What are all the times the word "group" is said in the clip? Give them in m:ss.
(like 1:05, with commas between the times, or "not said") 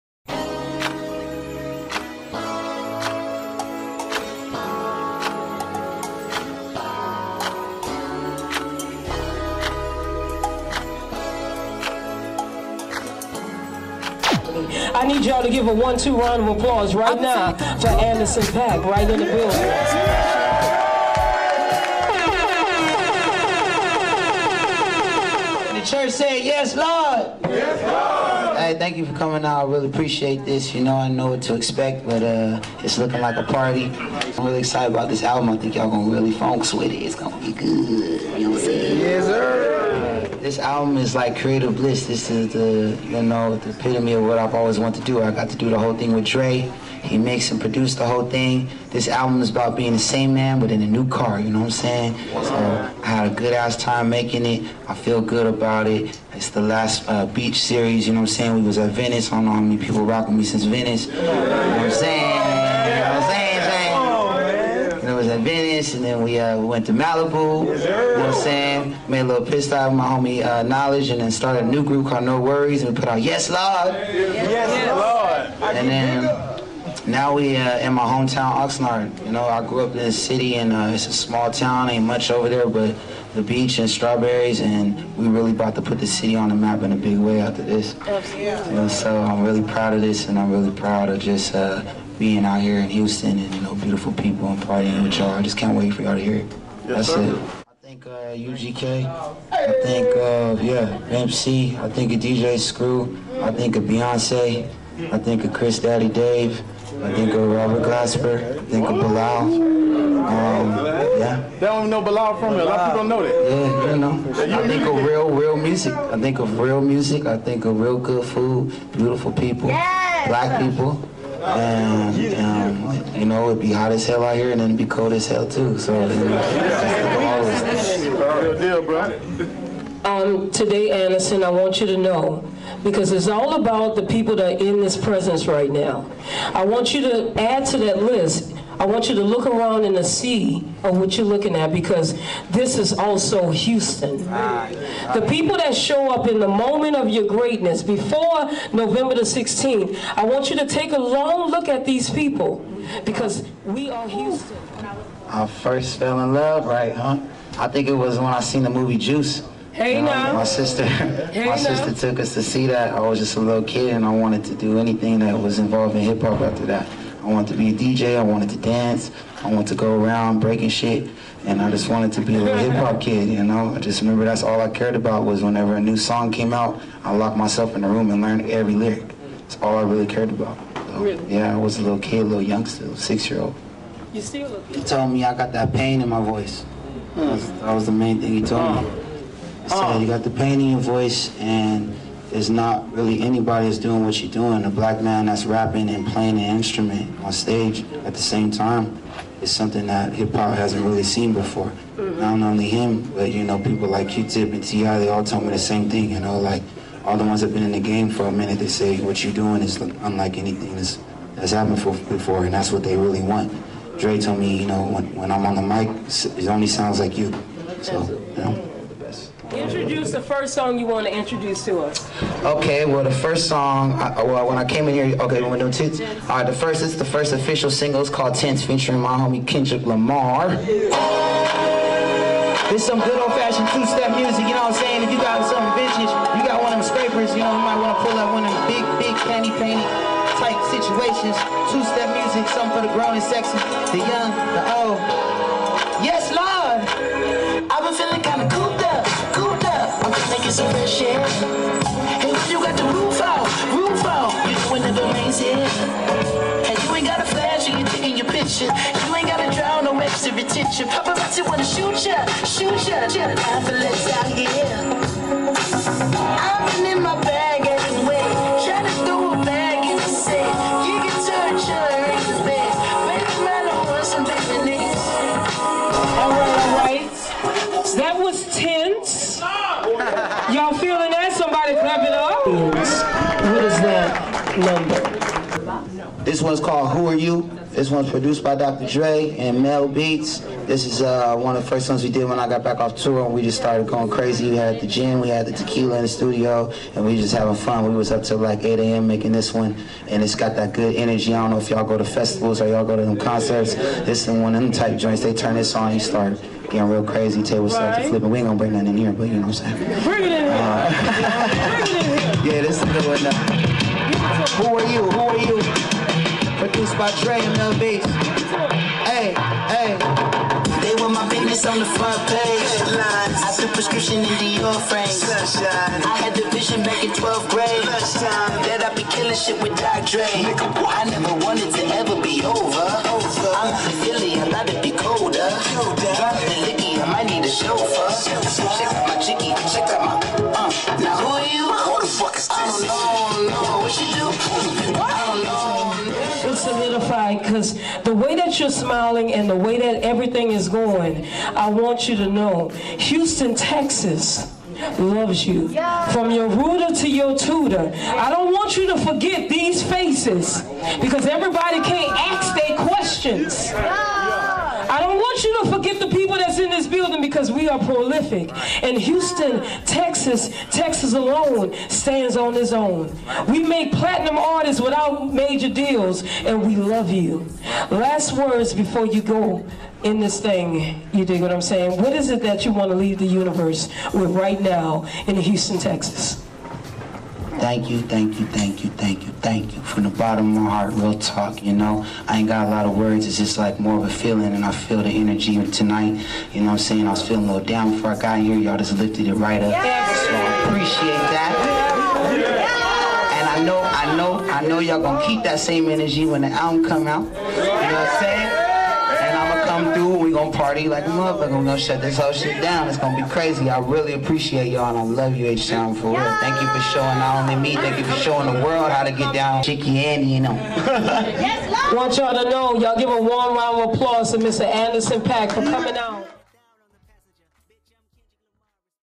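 1:11.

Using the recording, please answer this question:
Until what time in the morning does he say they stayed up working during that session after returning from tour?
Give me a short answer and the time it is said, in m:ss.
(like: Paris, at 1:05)
8 a.m., at 4:58.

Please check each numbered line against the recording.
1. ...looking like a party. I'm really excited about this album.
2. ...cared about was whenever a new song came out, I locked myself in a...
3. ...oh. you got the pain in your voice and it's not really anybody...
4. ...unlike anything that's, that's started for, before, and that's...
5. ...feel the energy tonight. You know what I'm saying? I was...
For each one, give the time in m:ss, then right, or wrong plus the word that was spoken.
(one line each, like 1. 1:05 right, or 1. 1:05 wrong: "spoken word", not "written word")
1. 0:32 right
2. 2:54 right
3. 3:09 right
4. 3:29 wrong: "happened", not "started"
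5. 6:34 right.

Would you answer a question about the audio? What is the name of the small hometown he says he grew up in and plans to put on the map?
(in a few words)
Oxnard.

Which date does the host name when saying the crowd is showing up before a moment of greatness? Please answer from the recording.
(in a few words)
November 16.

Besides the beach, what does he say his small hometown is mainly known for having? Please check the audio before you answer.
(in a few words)
Strawberries.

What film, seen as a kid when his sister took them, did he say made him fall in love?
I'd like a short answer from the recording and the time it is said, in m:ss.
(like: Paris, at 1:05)
Juice, at 2:38.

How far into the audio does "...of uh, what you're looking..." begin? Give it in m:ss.
2:20.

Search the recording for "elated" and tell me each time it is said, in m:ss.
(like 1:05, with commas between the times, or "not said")
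not said.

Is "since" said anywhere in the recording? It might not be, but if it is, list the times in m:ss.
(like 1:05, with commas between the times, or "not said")
1:00.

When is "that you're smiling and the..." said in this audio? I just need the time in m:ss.
5:48.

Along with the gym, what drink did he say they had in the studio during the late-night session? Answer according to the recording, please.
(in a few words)
Tequila.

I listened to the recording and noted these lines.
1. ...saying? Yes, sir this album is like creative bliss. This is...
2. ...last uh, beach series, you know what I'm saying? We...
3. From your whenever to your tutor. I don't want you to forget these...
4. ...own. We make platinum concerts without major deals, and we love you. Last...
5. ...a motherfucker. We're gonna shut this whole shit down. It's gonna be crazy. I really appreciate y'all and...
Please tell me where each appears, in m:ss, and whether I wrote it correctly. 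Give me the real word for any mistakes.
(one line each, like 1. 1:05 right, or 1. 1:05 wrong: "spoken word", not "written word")
1. 0:38 right
2. 0:56 right
3. 5:56 wrong: "rooter", not "whenever"
4. 6:12 wrong: "artists", not "concerts"
5. 6:51 right.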